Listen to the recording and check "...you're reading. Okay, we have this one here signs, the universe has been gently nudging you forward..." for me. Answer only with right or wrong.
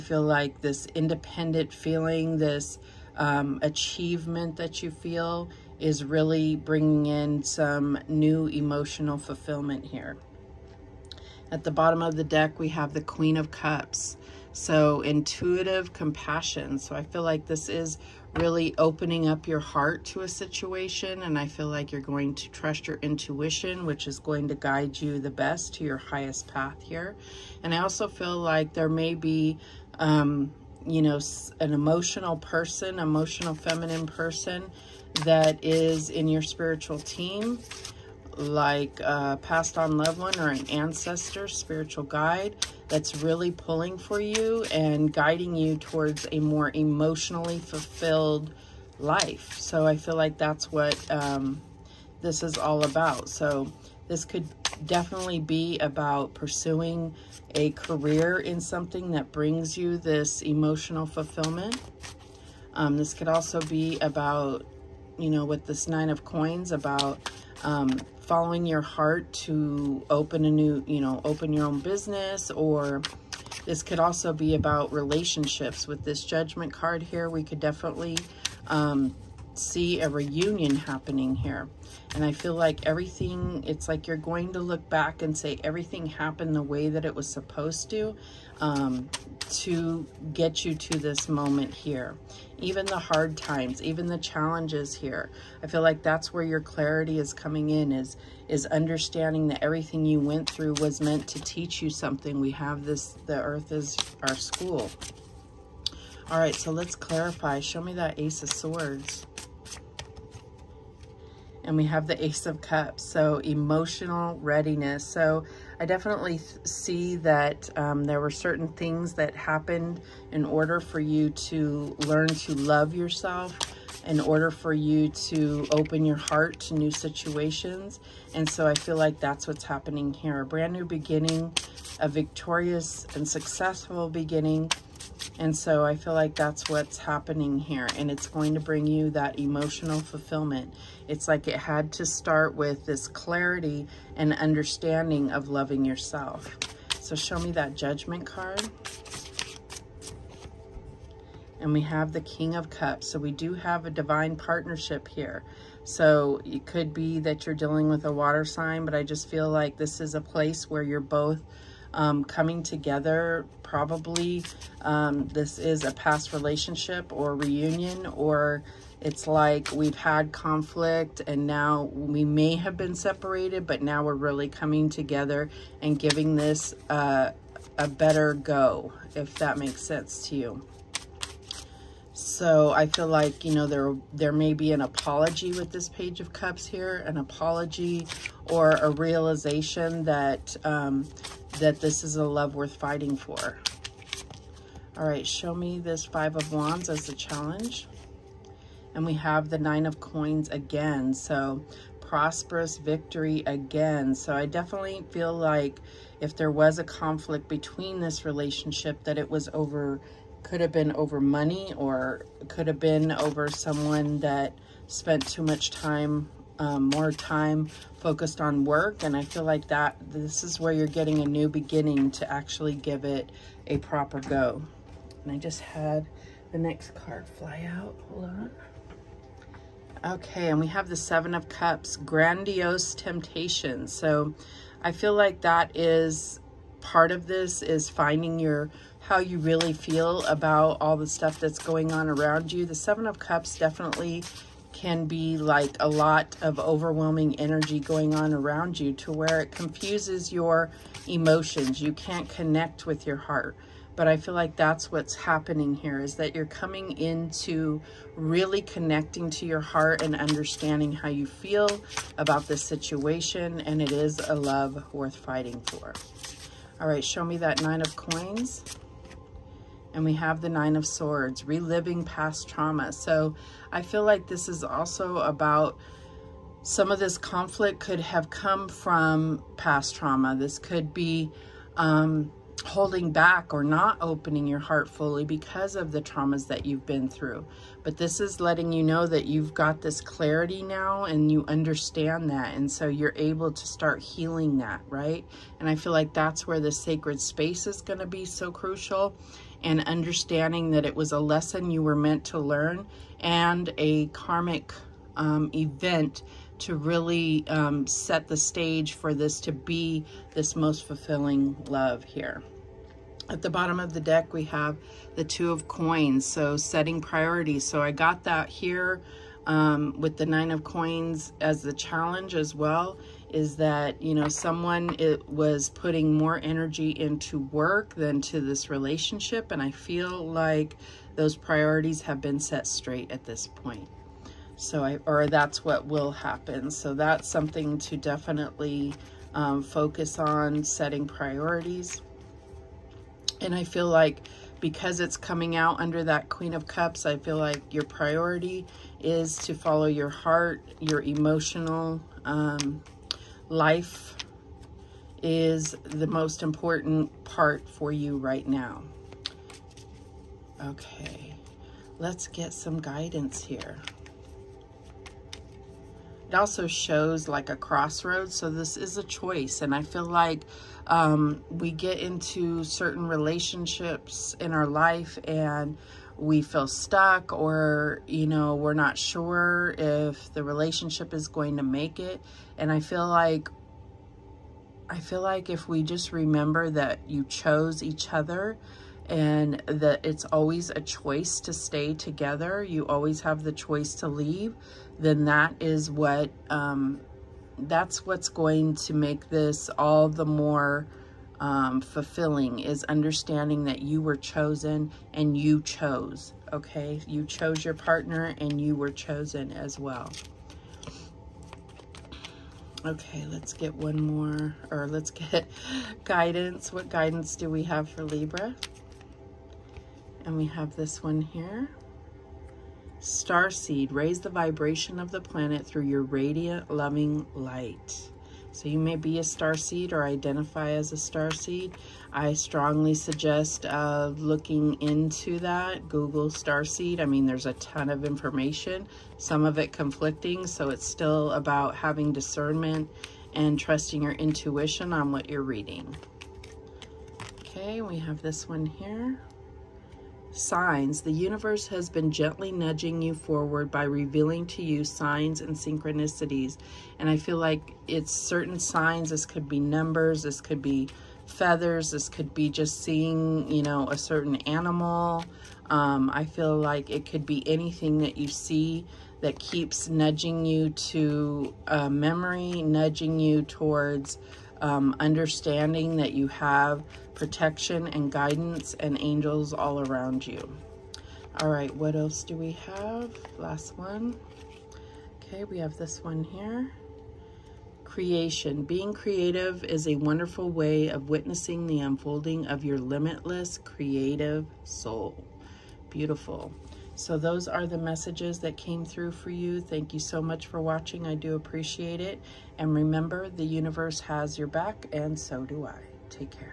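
right.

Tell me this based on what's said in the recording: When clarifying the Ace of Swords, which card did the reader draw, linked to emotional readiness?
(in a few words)
Ace of Cups.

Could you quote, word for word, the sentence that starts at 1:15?
With this judgment card here, we could definitely um, see a reunion happening here.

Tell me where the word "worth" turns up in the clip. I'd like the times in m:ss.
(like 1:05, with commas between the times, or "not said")
3:12, 4:24.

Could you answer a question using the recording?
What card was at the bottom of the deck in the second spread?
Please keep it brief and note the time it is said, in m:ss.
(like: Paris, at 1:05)
Two of Coins, at 5:15.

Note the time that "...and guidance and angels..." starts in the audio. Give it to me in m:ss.
7:57.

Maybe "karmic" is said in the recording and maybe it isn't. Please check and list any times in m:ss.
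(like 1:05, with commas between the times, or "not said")
5:04.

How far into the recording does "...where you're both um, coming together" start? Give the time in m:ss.
2:40.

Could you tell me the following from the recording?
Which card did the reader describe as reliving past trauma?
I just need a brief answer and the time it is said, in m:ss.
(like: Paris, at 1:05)
Nine of Swords, at 4:30.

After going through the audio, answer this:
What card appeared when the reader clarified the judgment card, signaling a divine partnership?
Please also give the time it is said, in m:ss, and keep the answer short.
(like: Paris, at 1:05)
King of Cups, at 2:32.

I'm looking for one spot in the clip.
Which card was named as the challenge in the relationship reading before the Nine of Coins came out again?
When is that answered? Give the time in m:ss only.
3:16.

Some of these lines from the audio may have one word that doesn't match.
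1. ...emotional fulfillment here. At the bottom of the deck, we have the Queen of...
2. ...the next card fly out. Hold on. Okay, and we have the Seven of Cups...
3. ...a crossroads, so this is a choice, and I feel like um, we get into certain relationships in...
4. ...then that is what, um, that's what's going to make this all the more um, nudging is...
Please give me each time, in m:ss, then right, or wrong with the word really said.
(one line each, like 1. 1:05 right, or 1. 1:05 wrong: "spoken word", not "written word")
1. 0:08 right
2. 3:46 right
3. 6:07 right
4. 6:34 wrong: "fulfilling", not "nudging".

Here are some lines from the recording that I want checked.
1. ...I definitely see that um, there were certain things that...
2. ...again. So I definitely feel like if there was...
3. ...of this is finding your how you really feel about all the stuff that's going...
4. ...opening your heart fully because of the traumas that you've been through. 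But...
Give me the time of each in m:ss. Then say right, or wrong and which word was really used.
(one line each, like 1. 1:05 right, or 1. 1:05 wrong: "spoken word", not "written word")
1. 1:55 right
2. 3:23 right
3. 3:57 right
4. 4:43 right.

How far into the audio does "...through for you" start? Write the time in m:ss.
8:18.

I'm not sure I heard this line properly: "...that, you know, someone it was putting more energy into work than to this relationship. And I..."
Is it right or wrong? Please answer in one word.
right.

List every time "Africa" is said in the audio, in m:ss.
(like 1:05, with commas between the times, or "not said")
not said.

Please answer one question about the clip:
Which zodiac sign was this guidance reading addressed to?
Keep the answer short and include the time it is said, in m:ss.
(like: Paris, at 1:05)
Libra, at 6:58.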